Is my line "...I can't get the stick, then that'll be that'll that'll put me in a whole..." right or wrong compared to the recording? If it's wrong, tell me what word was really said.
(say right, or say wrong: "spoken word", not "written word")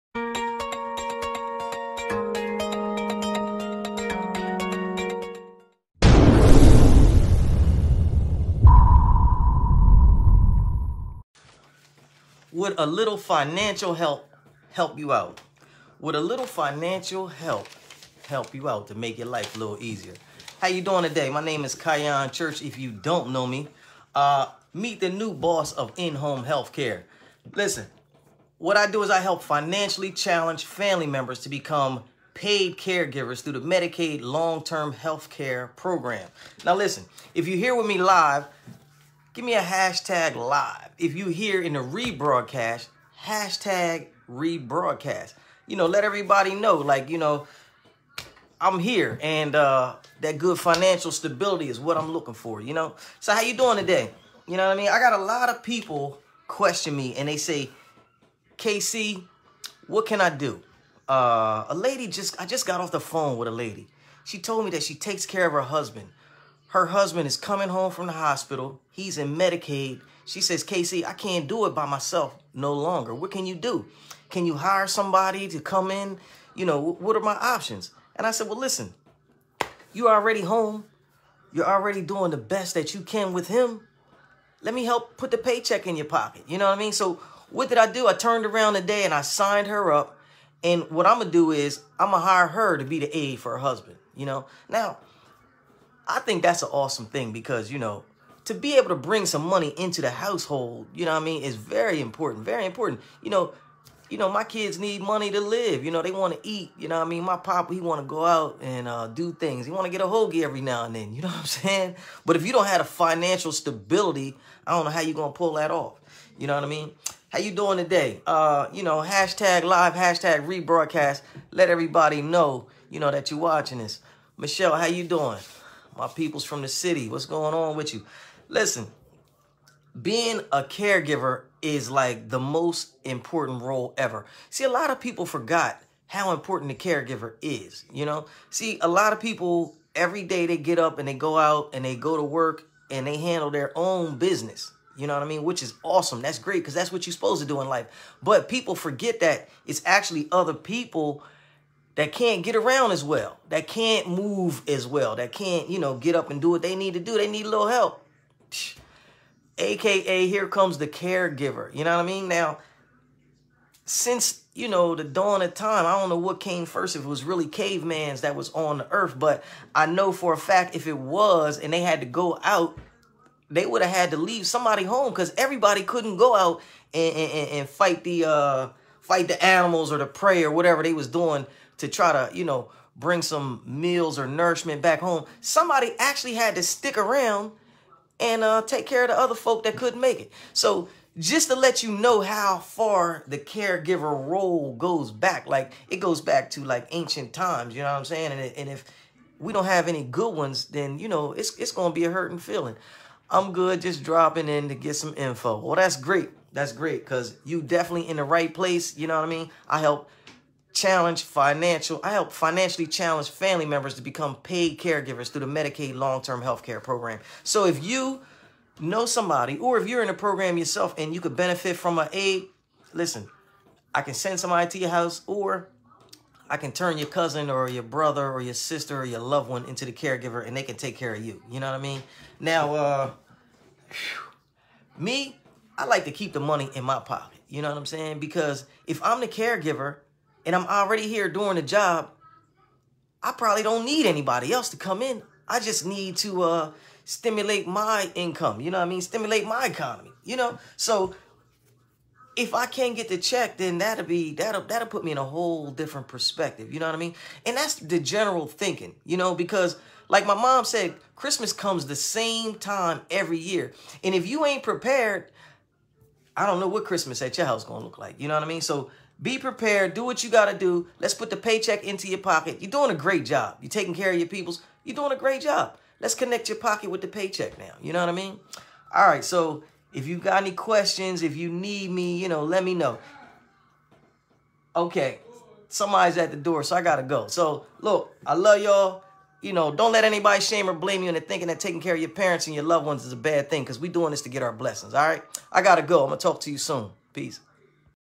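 wrong: "check", not "stick".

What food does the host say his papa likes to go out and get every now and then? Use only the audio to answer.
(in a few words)
A hoagie.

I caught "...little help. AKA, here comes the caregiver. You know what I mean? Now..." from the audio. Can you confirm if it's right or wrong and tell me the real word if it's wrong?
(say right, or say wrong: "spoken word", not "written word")
right.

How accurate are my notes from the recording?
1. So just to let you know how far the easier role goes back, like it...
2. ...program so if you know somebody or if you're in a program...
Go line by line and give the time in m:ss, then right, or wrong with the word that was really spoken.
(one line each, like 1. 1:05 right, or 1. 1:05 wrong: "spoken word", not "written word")
1. 3:10 wrong: "caregiver", not "easier"
2. 3:36 right.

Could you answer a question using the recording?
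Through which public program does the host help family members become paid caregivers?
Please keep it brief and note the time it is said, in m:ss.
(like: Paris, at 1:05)
Medicaid long-term healthcare program, at 0:33.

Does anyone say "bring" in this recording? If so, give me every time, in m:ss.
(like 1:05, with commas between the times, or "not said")
1:38, 3:02.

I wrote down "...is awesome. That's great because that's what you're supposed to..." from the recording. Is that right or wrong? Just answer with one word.
right.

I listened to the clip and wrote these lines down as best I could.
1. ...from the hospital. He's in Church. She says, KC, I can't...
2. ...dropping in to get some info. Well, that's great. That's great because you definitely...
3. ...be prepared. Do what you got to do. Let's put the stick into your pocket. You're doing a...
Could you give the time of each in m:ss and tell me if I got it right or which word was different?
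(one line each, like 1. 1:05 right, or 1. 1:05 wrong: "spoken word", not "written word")
1. 1:07 wrong: "Medicaid", not "Church"
2. 3:24 right
3. 4:29 wrong: "paycheck", not "stick".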